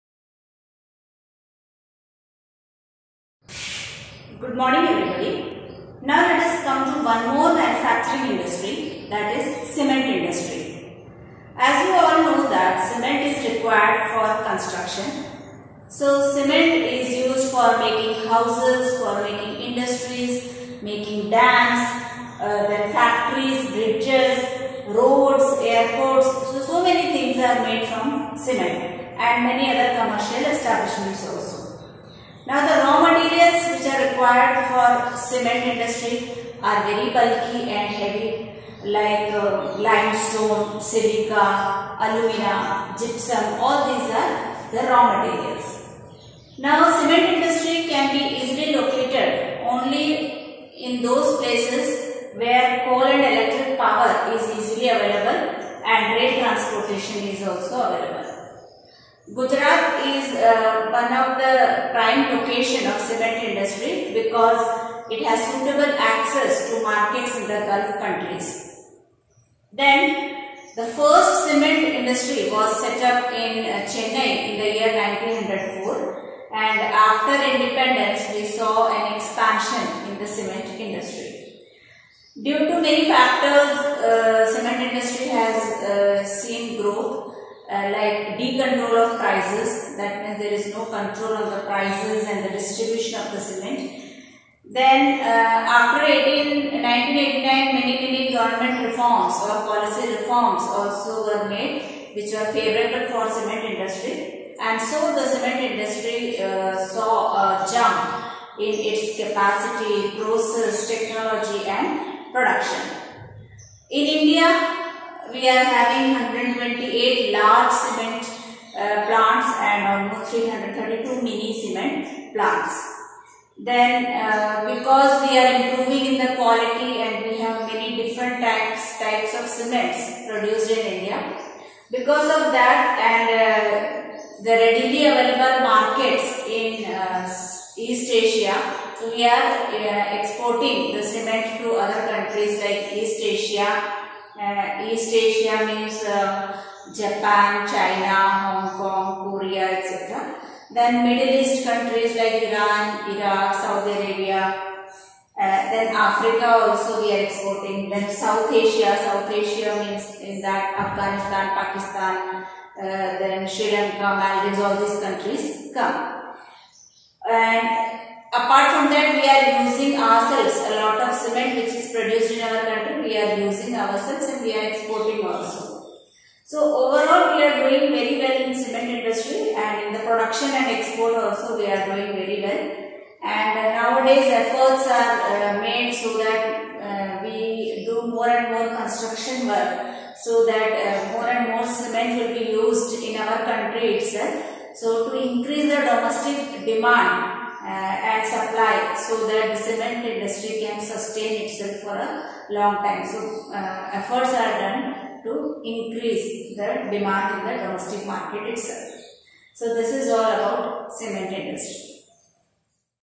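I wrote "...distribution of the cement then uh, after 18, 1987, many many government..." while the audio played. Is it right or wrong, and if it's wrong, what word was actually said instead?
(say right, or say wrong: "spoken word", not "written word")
wrong: "1989", not "1987".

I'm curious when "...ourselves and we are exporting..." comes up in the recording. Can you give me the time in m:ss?
2:53.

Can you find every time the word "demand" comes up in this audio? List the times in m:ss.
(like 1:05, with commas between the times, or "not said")
3:16, 3:26.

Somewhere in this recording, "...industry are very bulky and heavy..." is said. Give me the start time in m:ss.
0:35.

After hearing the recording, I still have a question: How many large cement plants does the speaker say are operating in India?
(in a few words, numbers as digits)
128.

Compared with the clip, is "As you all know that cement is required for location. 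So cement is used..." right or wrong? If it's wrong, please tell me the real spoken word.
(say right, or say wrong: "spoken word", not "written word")
wrong: "construction", not "location".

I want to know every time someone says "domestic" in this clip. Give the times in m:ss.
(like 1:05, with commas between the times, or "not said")
3:15, 3:27.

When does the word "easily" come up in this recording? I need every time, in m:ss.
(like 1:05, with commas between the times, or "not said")
0:48, 0:54.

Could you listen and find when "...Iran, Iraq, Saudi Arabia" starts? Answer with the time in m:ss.
2:32.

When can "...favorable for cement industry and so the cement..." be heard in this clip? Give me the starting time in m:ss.
1:42.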